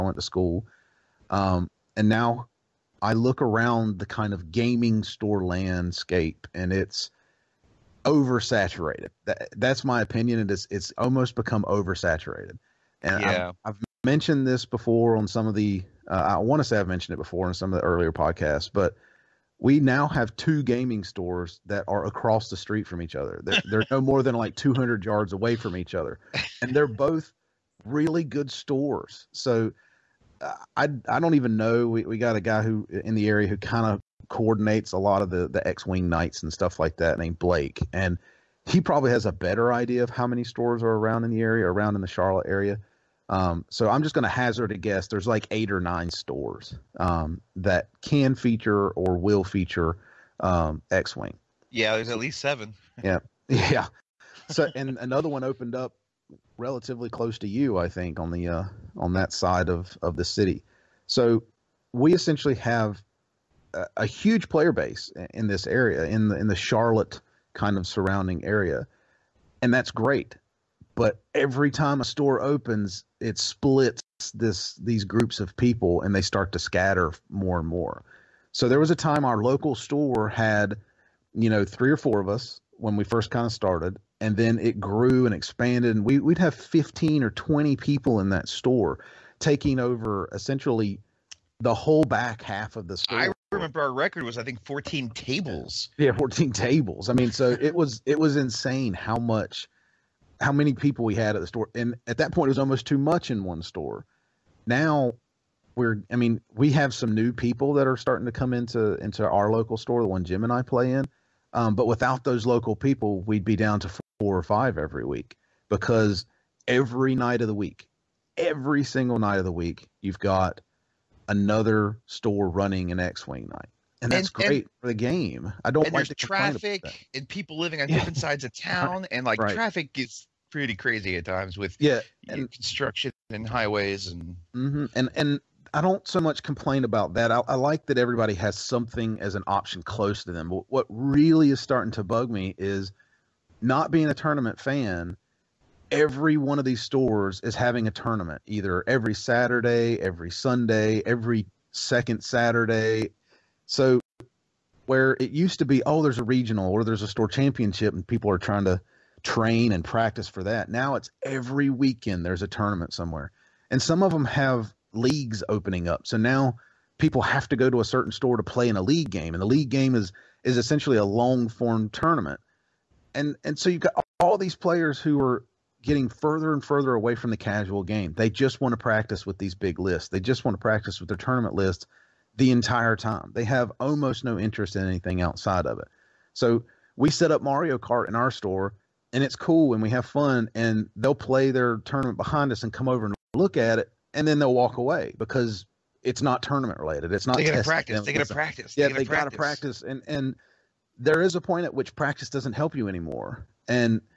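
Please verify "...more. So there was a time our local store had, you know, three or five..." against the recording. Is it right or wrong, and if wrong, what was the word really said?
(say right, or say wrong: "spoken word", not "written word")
wrong: "four", not "five".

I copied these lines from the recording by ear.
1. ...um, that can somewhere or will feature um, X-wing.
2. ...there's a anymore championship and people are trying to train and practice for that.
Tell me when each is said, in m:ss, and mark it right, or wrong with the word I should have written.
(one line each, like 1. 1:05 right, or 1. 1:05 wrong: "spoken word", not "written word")
1. 0:47 wrong: "feature", not "somewhere"
2. 2:36 wrong: "store", not "anymore".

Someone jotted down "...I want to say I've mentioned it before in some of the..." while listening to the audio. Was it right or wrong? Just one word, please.
right.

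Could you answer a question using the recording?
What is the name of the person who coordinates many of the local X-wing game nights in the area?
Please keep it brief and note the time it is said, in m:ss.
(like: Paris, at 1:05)
Blake, at 0:37.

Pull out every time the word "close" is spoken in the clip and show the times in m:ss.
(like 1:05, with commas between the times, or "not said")
0:57, 2:19.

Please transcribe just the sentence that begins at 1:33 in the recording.
I remember our record was I think 14 tables.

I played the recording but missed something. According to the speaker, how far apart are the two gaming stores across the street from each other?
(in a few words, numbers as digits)
200 yards.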